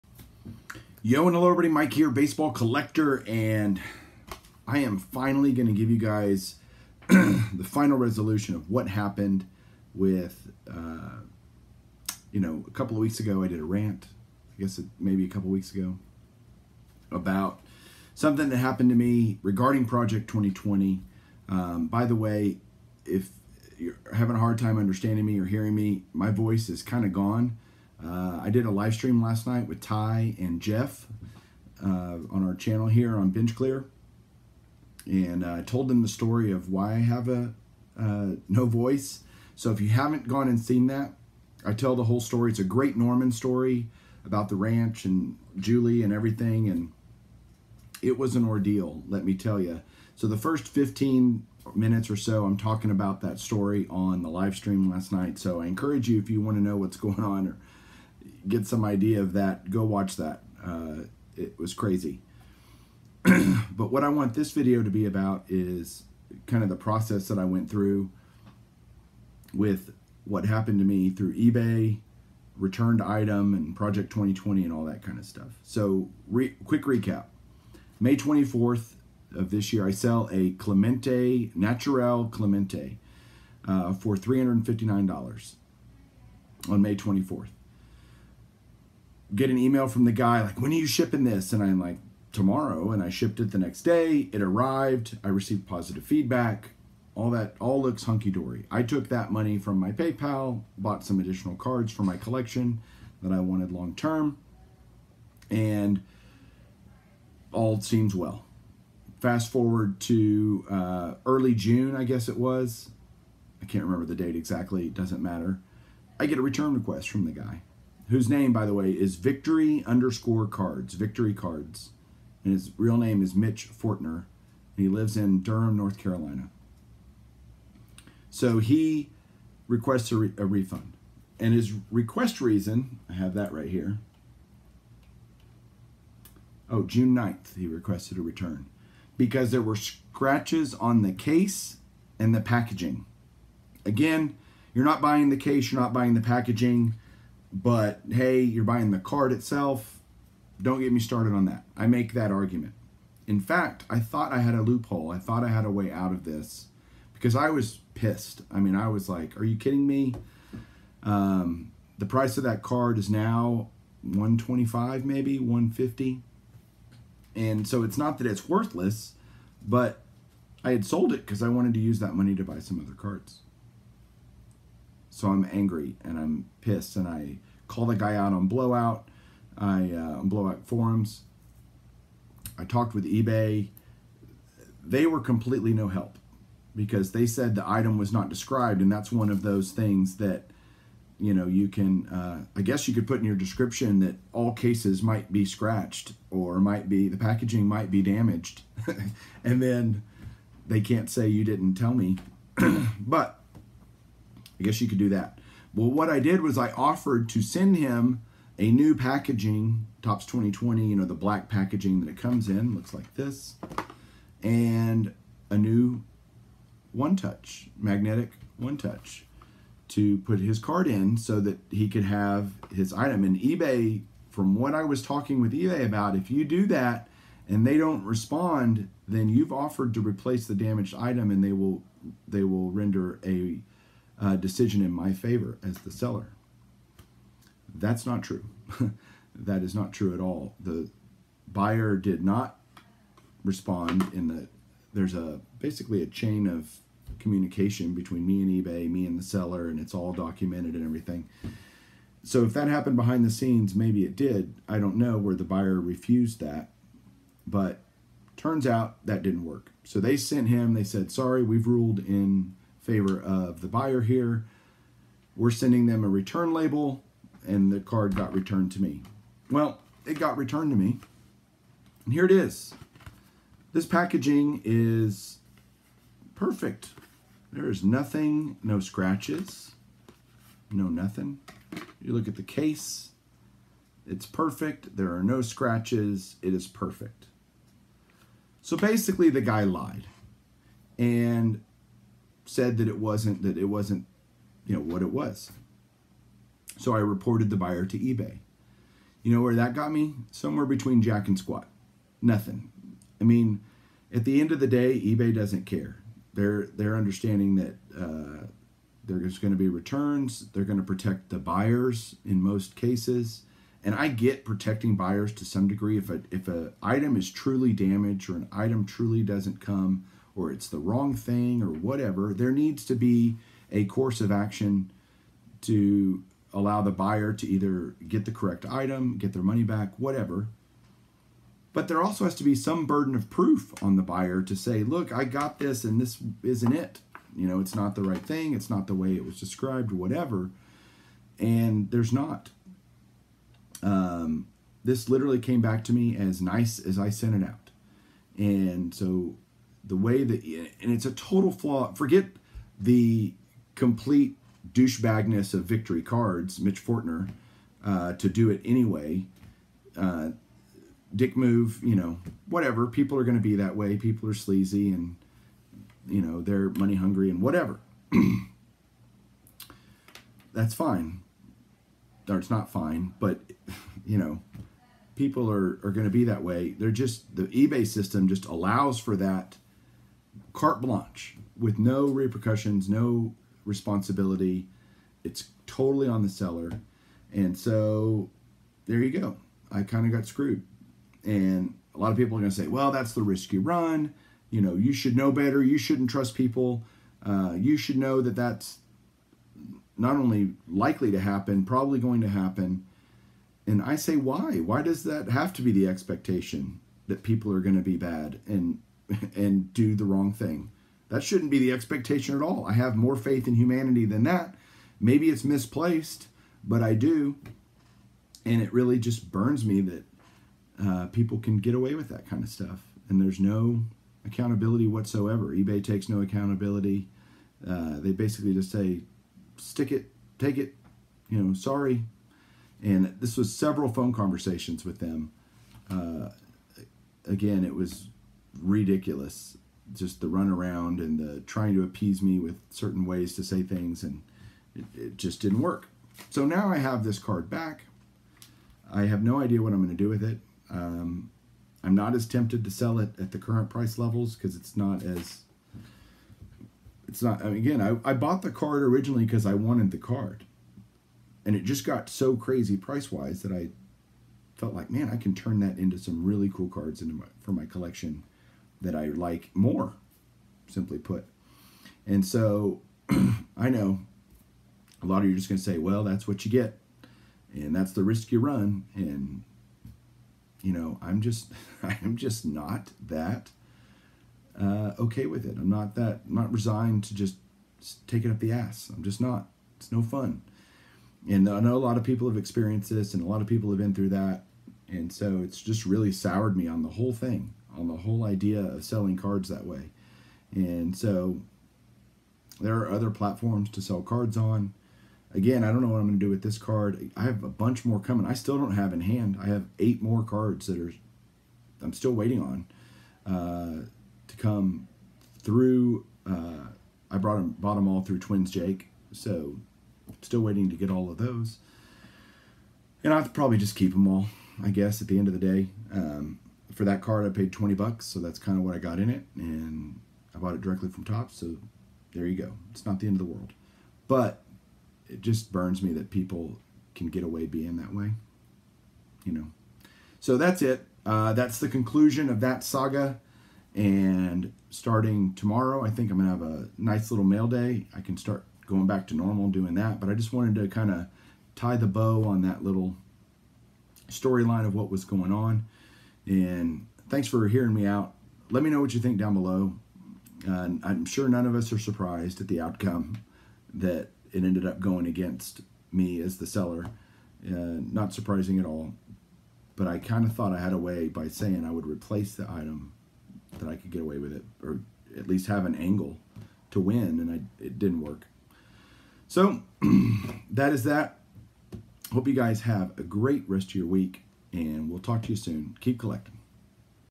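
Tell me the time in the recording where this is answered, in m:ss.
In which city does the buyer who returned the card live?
2:05.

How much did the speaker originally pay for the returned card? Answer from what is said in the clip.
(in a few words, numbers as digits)
$20.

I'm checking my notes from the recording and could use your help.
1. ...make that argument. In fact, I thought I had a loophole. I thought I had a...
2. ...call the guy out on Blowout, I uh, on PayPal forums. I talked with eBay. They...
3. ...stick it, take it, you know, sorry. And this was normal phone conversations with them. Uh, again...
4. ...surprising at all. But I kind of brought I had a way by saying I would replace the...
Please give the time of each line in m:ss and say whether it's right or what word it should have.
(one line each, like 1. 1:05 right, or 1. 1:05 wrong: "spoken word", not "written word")
1. 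2:31 right
2. 2:57 wrong: "Blowout", not "PayPal"
3. 7:09 wrong: "several", not "normal"
4. 9:28 wrong: "thought", not "brought".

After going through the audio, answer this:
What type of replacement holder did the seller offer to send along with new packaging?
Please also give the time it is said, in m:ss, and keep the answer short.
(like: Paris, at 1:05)
magnetic one touch, at 3:37.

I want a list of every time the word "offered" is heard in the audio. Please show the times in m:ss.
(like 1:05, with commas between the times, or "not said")
3:26, 3:49.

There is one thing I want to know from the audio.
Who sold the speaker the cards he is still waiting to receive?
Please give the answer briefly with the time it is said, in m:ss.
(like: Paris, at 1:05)
Twins Jake, at 8:38.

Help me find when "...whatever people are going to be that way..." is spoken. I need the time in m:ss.
6:02.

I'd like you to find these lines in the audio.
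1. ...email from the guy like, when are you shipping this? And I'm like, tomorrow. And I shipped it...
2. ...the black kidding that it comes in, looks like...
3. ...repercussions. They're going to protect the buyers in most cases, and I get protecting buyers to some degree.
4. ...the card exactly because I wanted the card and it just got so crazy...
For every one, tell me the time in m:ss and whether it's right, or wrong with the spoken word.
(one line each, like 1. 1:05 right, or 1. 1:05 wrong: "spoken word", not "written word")
1. 1:29 right
2. 3:31 wrong: "packaging", not "kidding"
3. 5:09 wrong: "returns", not "repercussions"
4. 7:38 wrong: "originally", not "exactly".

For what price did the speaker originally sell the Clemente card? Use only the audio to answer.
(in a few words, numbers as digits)
$359.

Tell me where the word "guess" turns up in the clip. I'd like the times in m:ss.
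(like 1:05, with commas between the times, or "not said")
0:14, 1:52, 3:12, 3:24, 8:44.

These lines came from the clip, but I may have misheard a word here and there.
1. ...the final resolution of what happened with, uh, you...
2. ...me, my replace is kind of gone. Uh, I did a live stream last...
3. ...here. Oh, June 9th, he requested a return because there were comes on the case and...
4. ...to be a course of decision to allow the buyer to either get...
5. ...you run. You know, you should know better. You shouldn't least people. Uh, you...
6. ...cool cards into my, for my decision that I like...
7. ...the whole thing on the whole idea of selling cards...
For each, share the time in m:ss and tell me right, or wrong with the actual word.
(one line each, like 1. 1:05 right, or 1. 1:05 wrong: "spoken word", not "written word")
1. 0:07 right
2. 0:25 wrong: "voice", not "replace"
3. 2:13 wrong: "scratches", not "comes"
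4. 5:22 wrong: "action", not "decision"
5. 6:33 wrong: "trust", not "least"
6. 7:46 wrong: "collection", not "decision"
7. 8:16 right.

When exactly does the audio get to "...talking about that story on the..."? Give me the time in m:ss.
0:52.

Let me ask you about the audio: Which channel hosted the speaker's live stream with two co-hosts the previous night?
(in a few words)
Bench Clear.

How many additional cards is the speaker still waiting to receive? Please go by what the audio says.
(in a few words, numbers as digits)
8.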